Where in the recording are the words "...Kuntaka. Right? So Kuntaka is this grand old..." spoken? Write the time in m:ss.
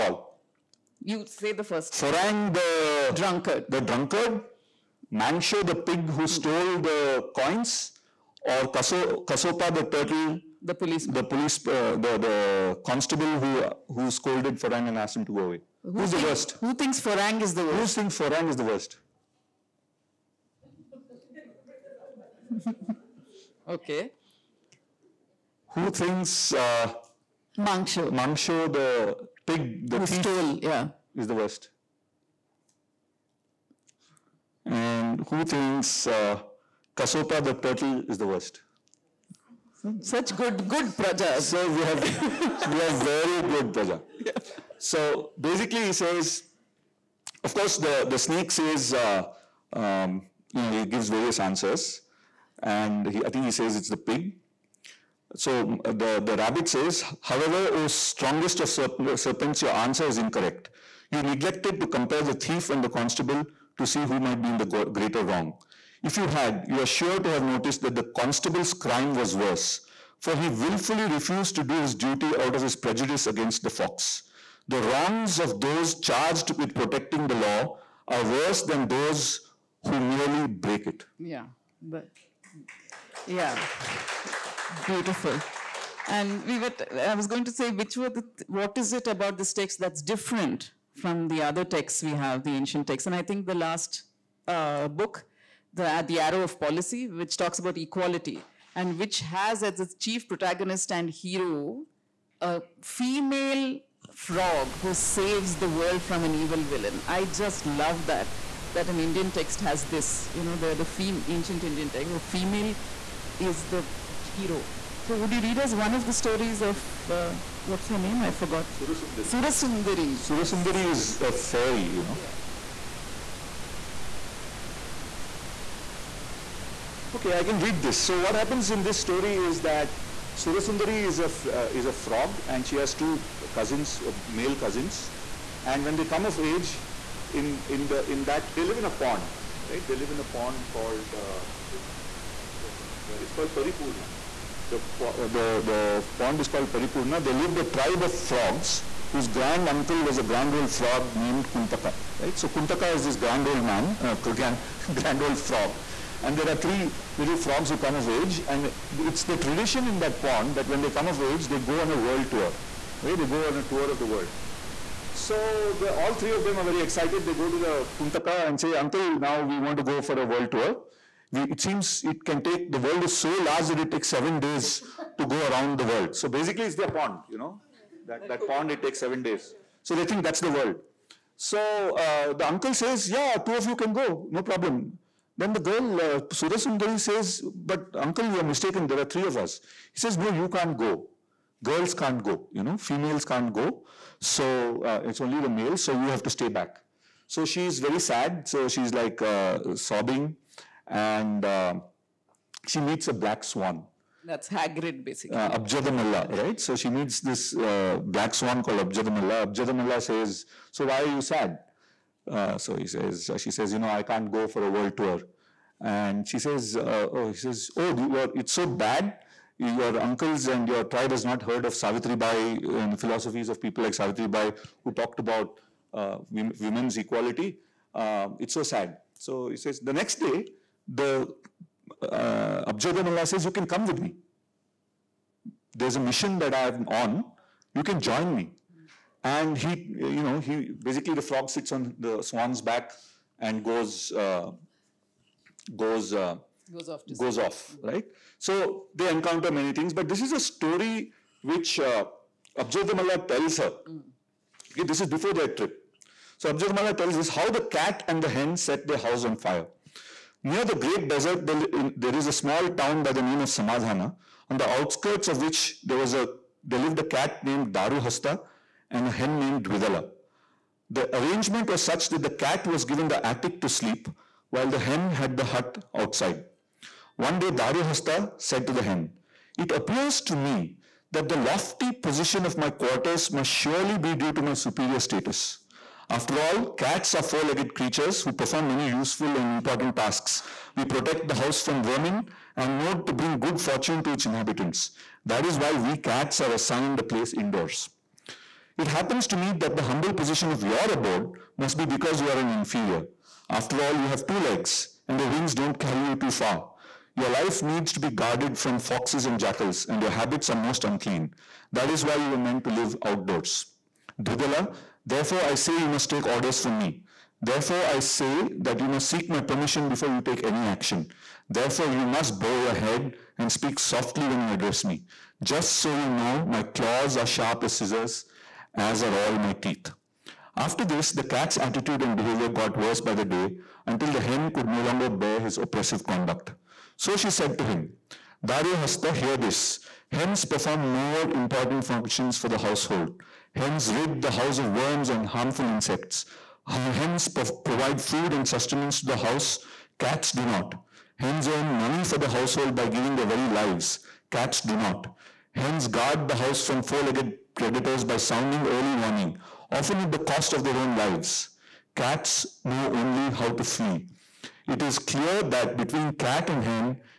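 2:31.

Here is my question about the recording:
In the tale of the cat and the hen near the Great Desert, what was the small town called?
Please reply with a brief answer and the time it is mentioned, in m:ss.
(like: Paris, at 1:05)
Samadhana, at 4:23.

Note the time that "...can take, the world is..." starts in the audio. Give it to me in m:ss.
2:52.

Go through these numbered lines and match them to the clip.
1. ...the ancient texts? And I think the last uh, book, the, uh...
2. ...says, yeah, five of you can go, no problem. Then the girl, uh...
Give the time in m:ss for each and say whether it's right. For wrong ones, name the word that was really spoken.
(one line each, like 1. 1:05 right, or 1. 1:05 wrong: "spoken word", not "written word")
1. 1:32 right
2. 3:02 wrong: "two", not "five".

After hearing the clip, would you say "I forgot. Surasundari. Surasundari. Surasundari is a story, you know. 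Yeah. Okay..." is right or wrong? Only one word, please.
wrong.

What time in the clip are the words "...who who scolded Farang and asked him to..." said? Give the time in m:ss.
0:13.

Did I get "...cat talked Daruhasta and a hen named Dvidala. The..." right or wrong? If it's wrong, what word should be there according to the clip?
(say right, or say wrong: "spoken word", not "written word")
wrong: "named", not "talked".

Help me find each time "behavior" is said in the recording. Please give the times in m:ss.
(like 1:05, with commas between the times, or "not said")
5:32.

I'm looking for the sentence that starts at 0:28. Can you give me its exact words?
Mangsho, the pig, the who thief, stole, yeah, is the worst.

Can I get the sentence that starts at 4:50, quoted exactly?
We protect the house from vermin and note to bring good fortune to its inhabitants.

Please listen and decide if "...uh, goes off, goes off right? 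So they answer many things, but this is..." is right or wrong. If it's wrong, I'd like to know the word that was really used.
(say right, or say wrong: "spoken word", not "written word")
wrong: "encounter", not "answer".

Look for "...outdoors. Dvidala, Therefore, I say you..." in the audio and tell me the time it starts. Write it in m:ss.
5:13.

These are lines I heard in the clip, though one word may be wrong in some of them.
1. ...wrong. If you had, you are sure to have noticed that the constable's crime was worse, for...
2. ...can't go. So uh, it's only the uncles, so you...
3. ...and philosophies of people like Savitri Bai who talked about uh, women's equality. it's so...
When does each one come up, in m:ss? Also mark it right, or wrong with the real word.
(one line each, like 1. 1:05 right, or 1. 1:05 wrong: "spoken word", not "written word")
1. 1:05 right
2. 3:13 wrong: "males", not "uncles"
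3. 3:42 right.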